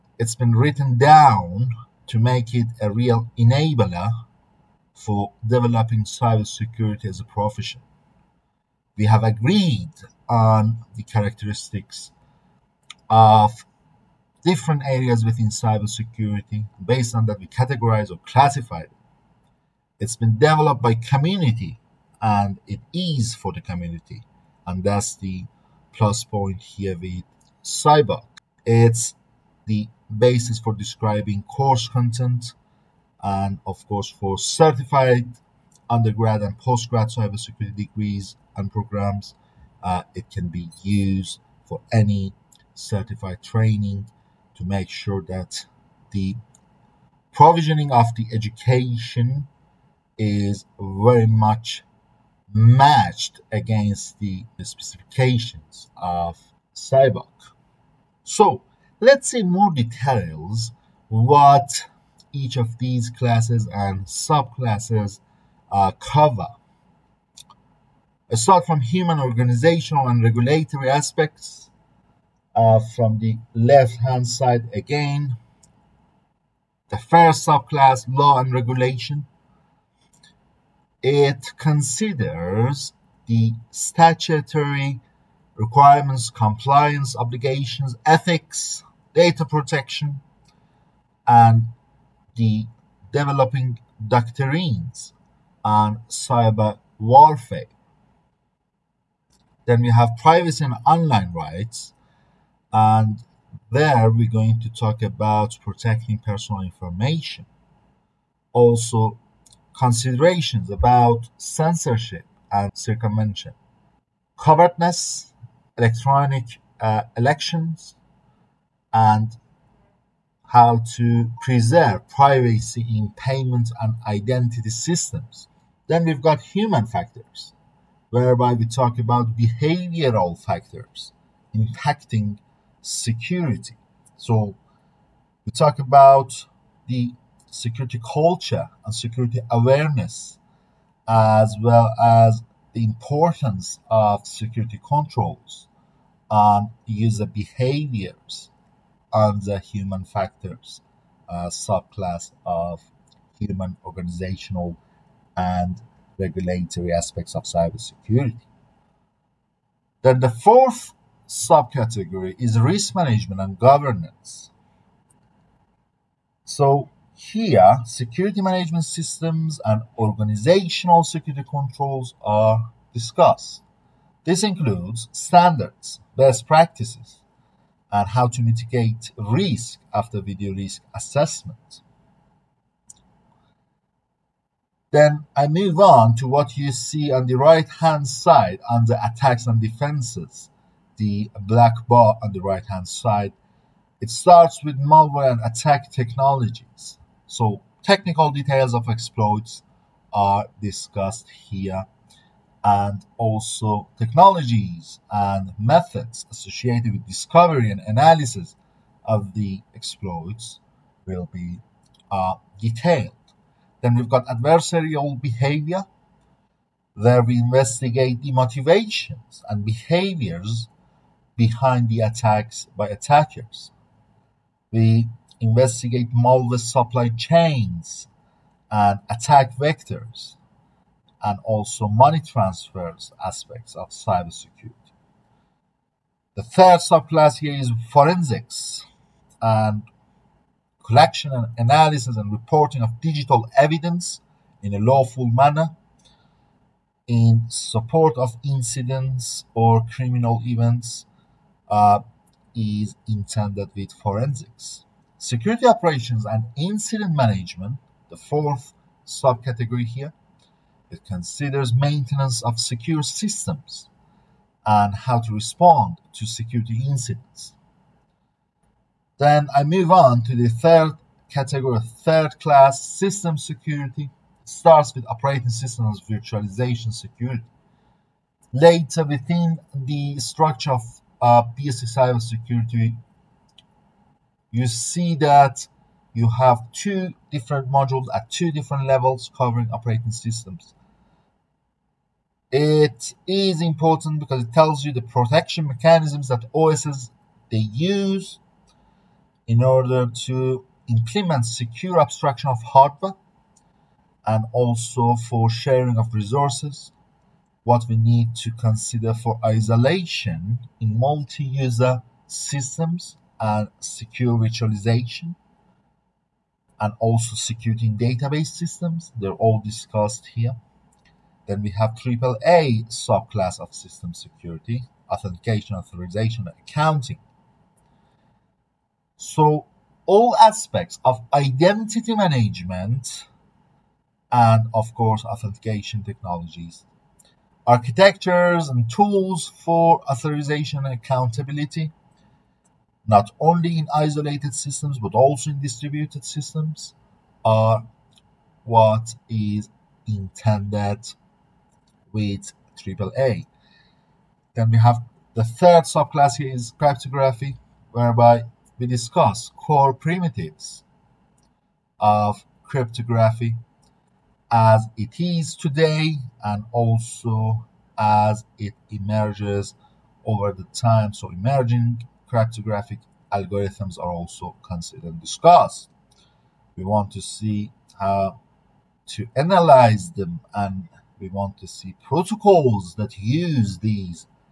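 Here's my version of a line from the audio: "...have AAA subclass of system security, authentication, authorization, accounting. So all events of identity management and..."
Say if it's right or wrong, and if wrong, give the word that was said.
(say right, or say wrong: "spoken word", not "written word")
wrong: "aspects", not "events".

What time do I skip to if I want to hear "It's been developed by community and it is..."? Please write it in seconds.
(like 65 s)
19 s.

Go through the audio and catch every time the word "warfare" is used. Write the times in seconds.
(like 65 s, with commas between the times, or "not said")
96 s.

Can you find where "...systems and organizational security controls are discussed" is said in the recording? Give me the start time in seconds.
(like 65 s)
168 s.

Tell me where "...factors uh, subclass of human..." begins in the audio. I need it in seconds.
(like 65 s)
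150 s.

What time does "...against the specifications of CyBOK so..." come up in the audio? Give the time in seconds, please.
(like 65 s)
53 s.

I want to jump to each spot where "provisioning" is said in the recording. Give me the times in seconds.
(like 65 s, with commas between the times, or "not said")
47 s.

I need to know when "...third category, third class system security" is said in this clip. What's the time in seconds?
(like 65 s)
270 s.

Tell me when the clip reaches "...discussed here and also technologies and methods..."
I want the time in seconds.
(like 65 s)
200 s.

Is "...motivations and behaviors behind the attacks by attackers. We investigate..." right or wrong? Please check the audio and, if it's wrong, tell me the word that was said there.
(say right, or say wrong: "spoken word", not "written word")
right.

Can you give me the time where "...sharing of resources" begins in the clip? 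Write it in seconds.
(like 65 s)
305 s.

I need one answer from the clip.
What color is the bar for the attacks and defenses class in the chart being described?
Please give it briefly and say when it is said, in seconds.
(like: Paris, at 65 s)
black, at 191 s.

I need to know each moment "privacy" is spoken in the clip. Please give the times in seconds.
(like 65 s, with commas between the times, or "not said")
100 s, 122 s.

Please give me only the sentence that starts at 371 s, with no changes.
So emerging cryptographic algorithms are also considered and discussed.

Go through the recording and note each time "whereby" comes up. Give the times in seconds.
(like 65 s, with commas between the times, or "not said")
128 s, 357 s.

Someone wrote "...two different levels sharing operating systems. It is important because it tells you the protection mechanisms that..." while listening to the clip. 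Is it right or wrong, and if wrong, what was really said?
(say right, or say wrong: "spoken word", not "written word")
wrong: "covering", not "sharing".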